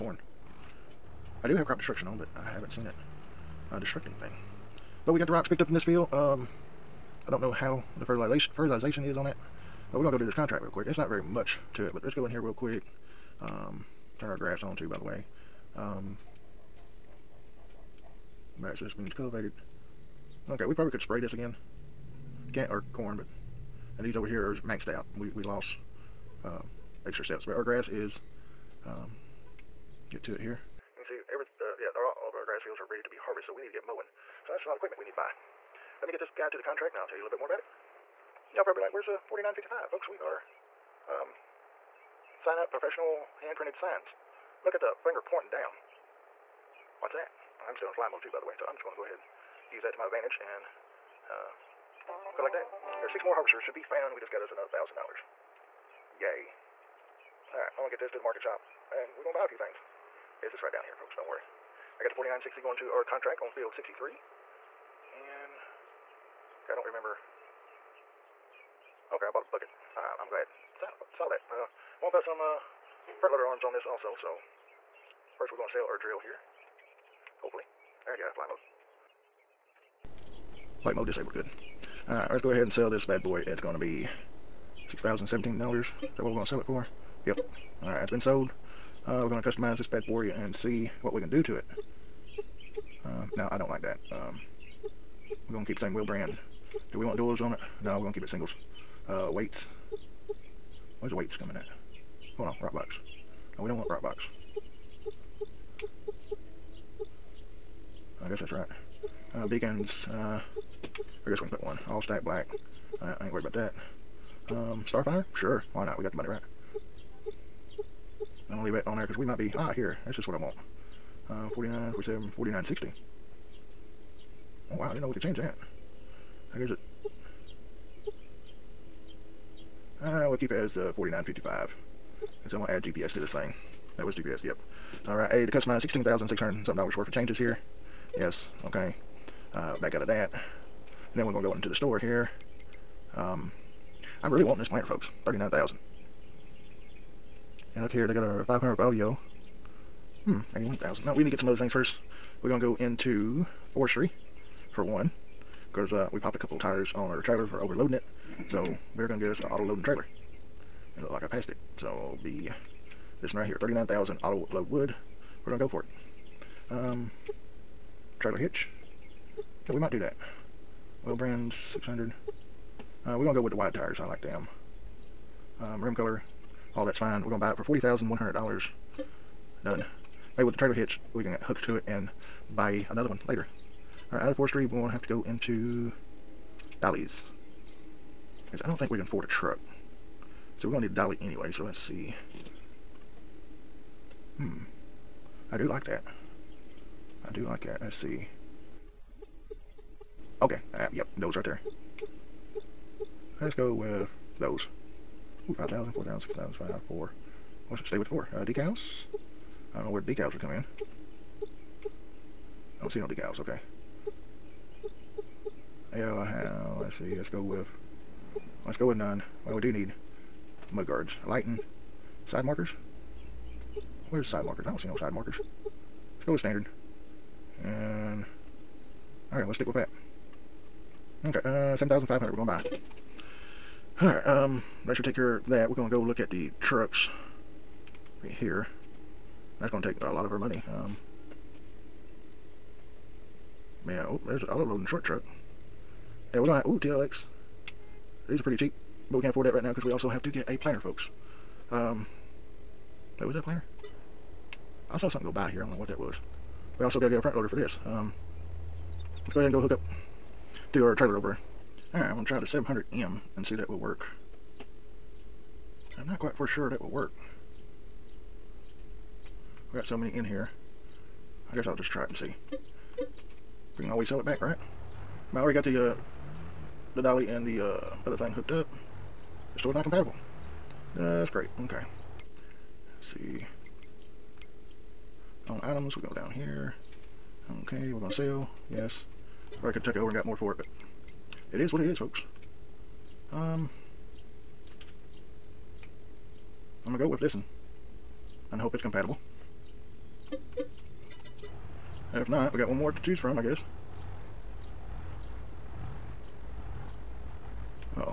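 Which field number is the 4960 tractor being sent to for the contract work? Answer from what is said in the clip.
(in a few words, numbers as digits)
63.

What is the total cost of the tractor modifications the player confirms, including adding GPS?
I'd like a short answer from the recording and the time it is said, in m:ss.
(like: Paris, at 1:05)
16600, at 2:15.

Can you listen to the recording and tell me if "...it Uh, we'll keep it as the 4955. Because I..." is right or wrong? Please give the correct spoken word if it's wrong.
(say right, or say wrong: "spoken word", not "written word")
right.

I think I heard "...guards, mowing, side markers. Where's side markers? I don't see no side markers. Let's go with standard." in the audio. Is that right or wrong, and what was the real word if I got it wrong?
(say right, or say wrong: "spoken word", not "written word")
wrong: "lighting", not "mowing".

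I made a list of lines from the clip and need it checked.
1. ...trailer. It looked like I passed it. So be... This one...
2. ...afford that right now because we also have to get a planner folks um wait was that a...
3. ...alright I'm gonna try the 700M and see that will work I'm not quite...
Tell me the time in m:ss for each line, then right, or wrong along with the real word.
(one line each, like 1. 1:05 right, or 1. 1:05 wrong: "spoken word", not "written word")
1. 2:39 right
2. 4:09 right
3. 4:21 right.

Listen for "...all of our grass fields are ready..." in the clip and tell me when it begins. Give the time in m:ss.
0:32.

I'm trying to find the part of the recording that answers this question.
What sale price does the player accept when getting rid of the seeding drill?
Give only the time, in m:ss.
1:24.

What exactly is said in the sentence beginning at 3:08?
Because I don't think we can afford a truck.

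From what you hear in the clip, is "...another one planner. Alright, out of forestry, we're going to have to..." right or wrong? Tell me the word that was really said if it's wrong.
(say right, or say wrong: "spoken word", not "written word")
wrong: "later", not "planner".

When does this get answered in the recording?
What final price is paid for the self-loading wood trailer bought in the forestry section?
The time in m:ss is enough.
2:57.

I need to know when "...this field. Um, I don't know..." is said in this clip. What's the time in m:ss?
0:05.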